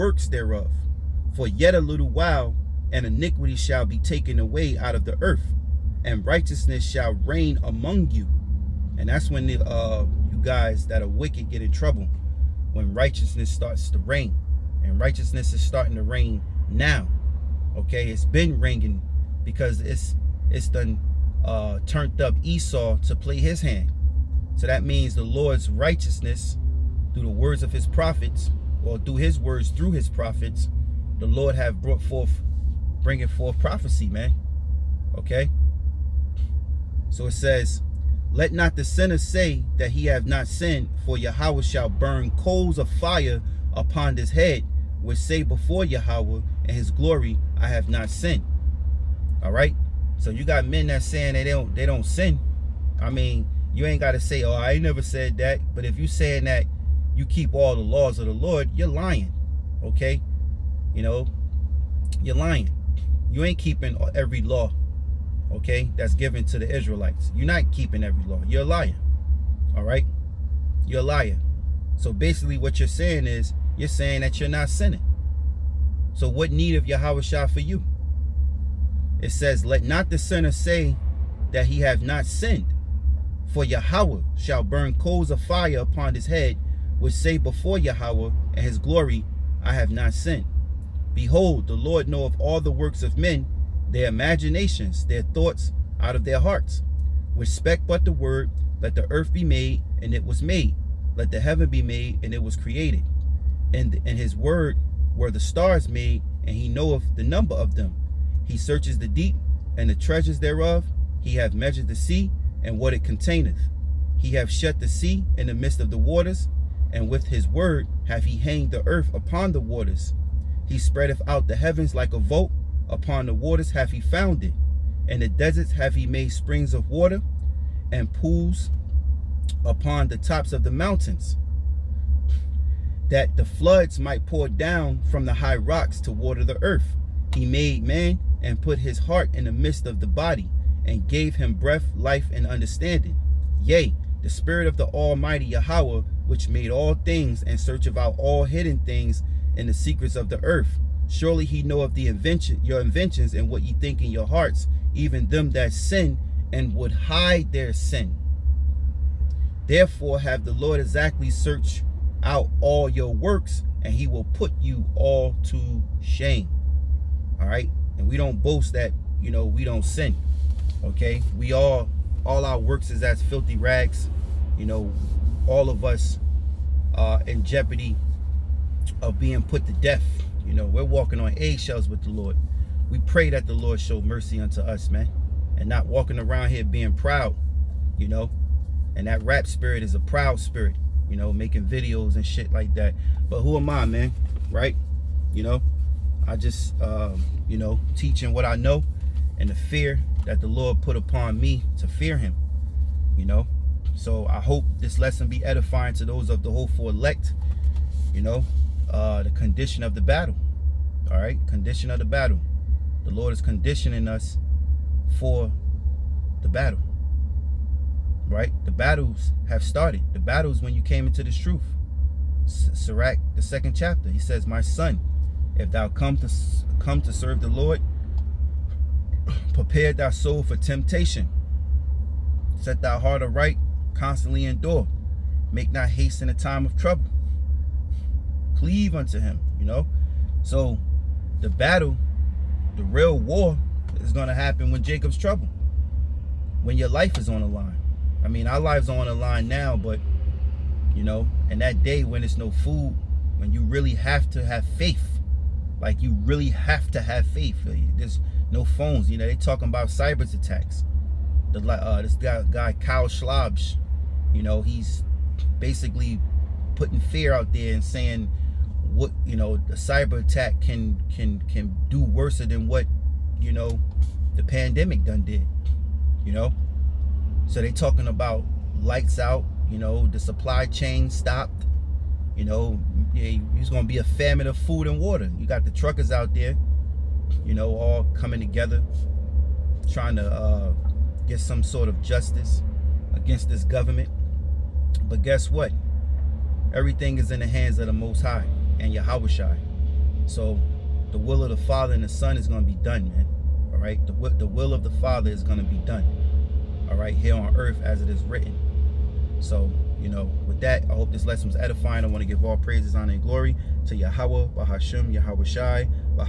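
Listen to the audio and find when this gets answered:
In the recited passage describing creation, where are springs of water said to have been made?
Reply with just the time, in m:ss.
2:05.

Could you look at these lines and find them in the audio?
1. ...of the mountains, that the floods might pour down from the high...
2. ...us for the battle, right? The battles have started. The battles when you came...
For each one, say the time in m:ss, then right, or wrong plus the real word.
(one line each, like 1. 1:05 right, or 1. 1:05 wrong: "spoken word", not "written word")
1. 2:10 right
2. 3:34 right.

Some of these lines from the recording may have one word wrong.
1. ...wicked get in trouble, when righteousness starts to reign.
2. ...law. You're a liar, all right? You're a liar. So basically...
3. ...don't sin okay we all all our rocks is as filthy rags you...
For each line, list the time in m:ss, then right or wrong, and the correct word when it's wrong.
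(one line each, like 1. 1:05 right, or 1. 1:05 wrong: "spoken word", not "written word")
1. 0:11 right
2. 1:08 right
3. 2:49 wrong: "works", not "rocks".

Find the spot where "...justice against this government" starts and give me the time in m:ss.
4:52.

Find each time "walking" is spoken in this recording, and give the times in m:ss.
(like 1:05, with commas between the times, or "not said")
3:00, 3:05.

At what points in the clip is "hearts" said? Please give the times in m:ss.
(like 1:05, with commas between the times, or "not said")
1:36, 2:18, 2:34, 3:52.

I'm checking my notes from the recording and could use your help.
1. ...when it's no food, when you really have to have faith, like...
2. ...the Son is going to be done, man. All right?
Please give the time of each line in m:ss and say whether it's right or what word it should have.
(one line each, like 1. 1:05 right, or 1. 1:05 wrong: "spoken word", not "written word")
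1. 4:12 right
2. 5:02 right.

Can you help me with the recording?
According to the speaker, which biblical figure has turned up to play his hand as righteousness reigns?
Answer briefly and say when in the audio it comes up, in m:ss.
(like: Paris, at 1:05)
Esau, at 0:22.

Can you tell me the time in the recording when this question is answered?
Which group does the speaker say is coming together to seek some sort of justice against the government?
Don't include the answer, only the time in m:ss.
4:45.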